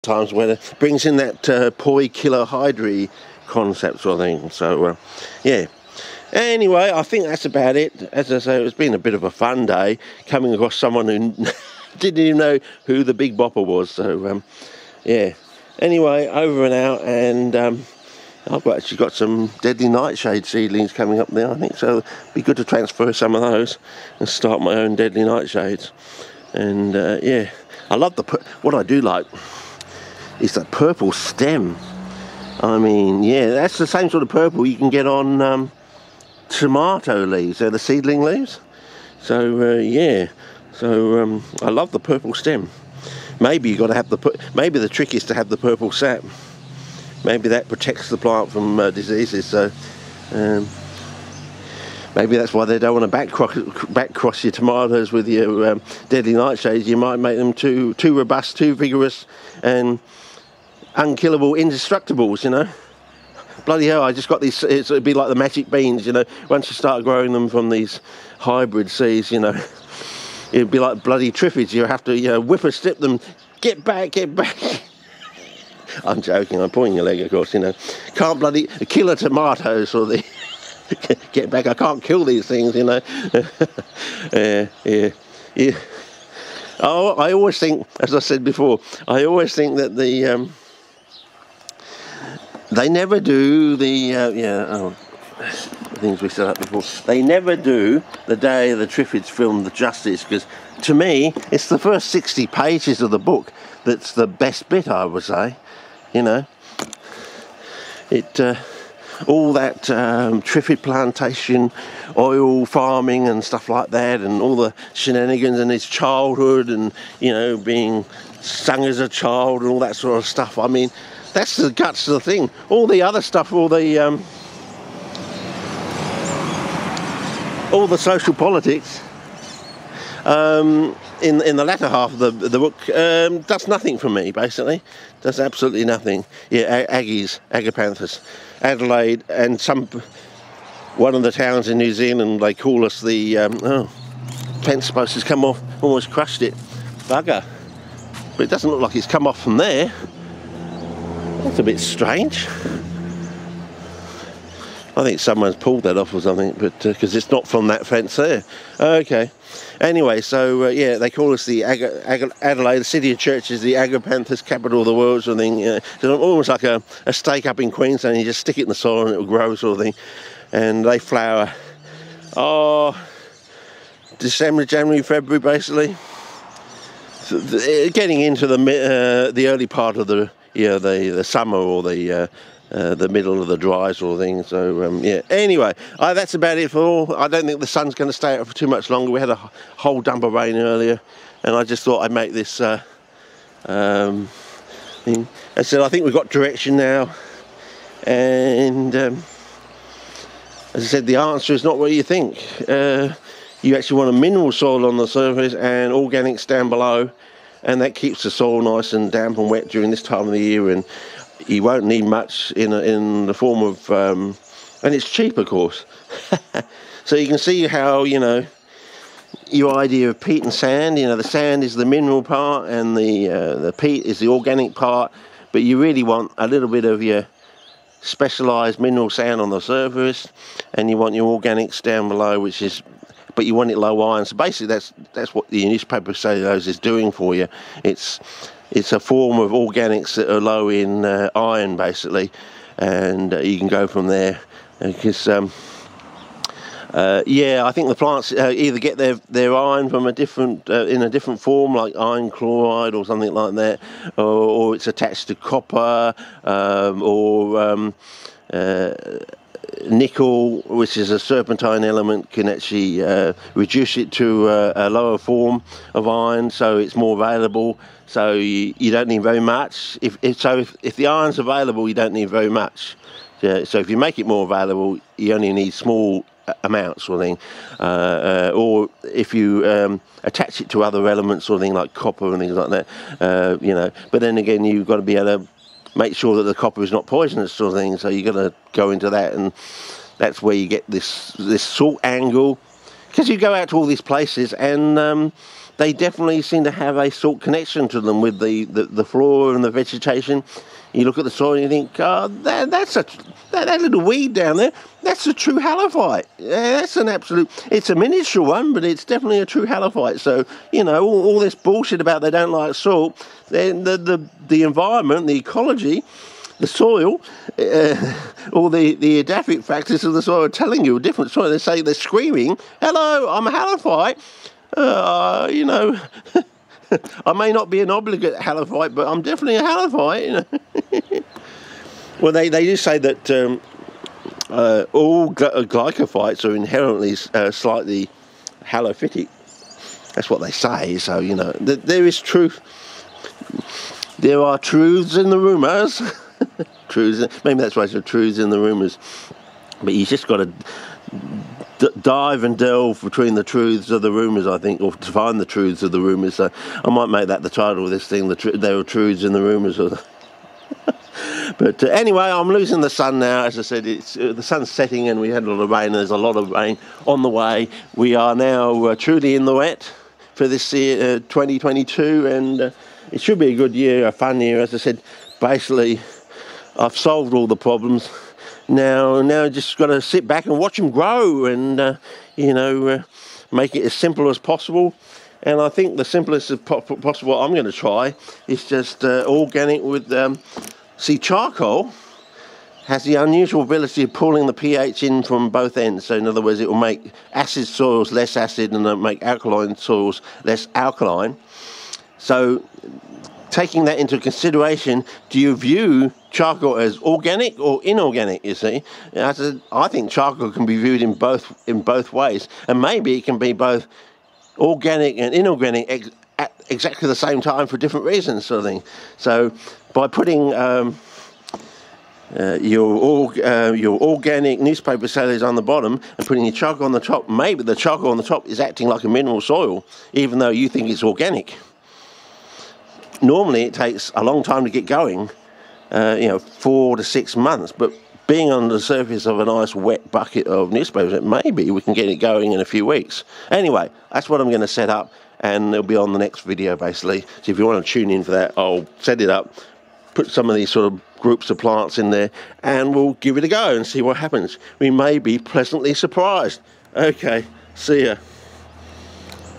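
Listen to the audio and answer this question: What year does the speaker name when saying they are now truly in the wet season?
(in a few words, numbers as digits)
2022.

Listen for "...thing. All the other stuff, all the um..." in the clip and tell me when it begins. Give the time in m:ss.
2:02.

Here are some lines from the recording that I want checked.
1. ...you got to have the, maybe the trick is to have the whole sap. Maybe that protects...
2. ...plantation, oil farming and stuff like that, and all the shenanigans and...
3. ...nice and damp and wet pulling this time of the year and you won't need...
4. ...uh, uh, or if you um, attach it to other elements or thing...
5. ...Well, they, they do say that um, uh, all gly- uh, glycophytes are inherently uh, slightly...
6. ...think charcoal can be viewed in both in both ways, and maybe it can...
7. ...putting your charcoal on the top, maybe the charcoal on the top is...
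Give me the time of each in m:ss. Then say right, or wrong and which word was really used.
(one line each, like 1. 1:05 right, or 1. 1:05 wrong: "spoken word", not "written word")
1. 0:43 wrong: "purple", not "whole"
2. 1:50 right
3. 3:28 wrong: "during", not "pulling"
4. 4:37 right
5. 5:32 right
6. 6:49 right
7. 7:06 right.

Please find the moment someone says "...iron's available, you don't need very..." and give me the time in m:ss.
4:31.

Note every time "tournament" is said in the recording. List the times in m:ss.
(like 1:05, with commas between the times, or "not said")
not said.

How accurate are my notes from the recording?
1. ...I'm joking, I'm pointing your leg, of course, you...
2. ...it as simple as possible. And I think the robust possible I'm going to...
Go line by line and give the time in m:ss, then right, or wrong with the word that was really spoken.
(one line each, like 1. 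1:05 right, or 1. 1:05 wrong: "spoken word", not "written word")
1. 1:16 right
2. 6:23 wrong: "simplest", not "robust".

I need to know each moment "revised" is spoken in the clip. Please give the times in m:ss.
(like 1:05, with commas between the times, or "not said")
not said.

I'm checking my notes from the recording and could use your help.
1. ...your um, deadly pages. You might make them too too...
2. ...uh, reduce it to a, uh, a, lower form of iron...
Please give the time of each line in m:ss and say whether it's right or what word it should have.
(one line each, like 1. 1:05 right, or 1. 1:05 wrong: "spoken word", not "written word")
1. 0:55 wrong: "nightshades", not "pages"
2. 4:23 right.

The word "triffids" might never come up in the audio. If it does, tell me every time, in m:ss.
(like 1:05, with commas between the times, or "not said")
1:11, 1:38, 1:50.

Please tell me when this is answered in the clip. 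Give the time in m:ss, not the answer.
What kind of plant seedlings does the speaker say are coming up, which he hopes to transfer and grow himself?
0:19.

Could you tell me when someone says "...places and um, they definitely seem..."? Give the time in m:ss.
4:54.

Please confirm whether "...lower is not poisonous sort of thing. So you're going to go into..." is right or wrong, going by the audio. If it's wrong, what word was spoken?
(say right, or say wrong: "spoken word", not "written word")
wrong: "copper", not "lower".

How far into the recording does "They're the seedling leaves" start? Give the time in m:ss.
0:37.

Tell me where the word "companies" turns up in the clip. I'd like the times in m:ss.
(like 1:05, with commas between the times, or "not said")
not said.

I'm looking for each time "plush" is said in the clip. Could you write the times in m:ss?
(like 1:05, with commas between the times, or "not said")
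not said.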